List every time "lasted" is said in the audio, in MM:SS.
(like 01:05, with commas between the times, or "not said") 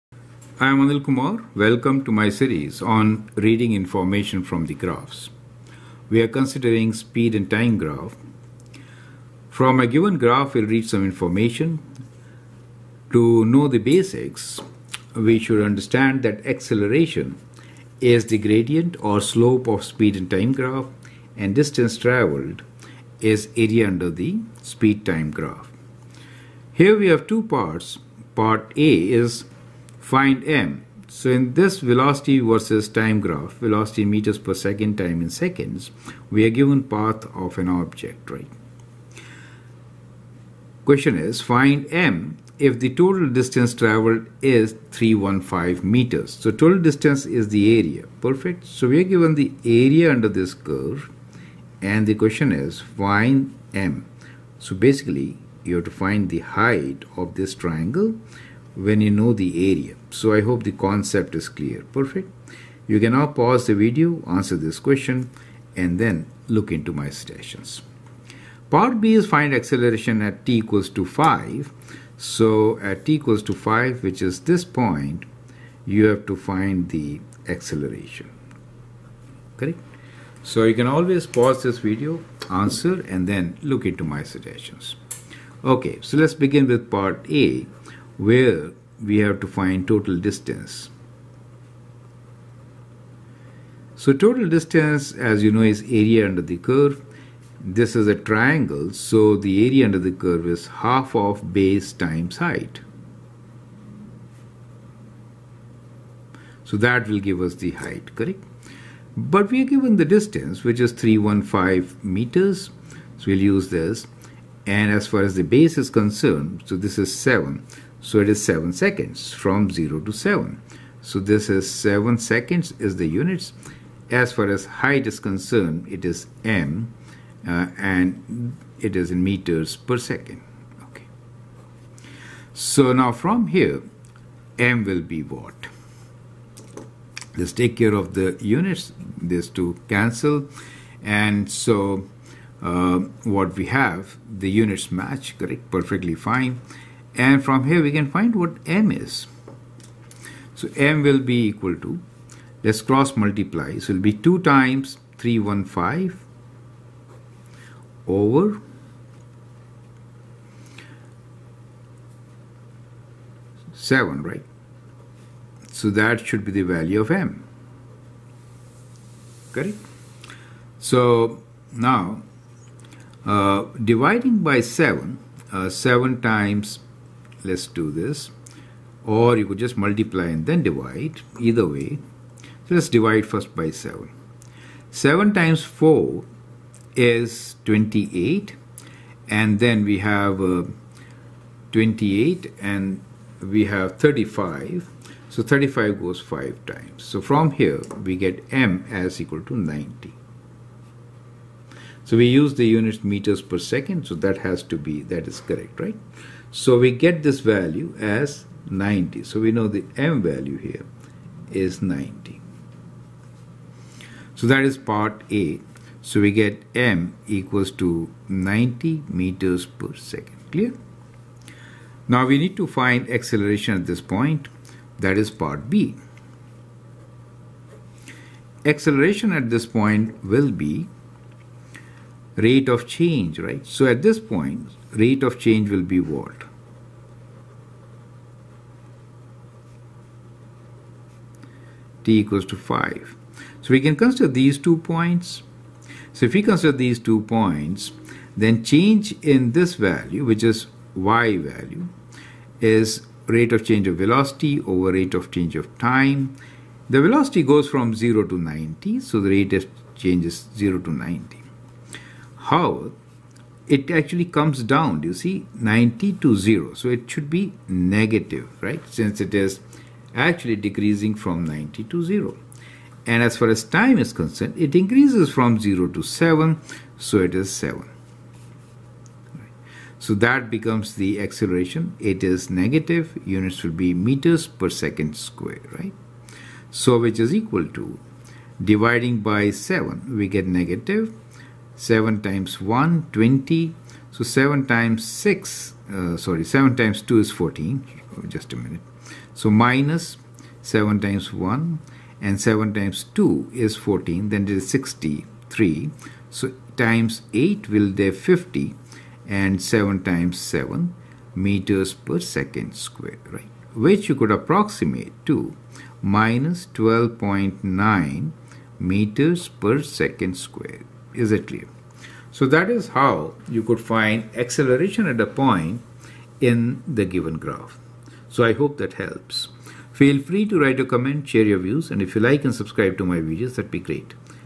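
not said.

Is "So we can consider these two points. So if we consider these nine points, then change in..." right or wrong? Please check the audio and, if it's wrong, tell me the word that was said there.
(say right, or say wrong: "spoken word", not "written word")
wrong: "two", not "nine".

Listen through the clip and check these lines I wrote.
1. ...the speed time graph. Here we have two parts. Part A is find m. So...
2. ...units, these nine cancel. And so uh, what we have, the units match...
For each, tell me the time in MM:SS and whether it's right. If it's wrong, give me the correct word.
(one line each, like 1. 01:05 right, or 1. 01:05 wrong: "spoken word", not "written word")
1. 00:24 right
2. 02:18 wrong: "two", not "nine".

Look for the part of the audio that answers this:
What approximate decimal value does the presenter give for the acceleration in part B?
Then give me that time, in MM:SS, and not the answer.
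05:16.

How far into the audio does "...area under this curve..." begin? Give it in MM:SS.
00:49.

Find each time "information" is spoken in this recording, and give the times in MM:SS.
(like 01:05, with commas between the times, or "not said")
00:03, 00:11.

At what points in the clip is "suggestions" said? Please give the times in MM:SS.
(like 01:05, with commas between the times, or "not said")
01:07, 01:24.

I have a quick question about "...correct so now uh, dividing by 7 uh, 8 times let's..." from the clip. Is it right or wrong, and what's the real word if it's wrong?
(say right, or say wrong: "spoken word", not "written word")
wrong: "7", not "8".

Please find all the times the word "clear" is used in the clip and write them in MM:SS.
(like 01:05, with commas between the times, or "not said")
01:01, 03:40, 05:21.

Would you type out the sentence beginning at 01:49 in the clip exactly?
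But we are given the distance which is 315 meters.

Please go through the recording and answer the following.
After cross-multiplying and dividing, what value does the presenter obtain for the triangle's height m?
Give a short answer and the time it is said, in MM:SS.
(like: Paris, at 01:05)
90, at 03:18.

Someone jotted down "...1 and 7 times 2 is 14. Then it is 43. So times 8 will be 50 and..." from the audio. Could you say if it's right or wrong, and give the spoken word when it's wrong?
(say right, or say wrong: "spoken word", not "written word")
wrong: "63", not "43".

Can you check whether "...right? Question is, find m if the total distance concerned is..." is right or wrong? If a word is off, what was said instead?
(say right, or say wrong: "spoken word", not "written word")
wrong: "traveled", not "concerned".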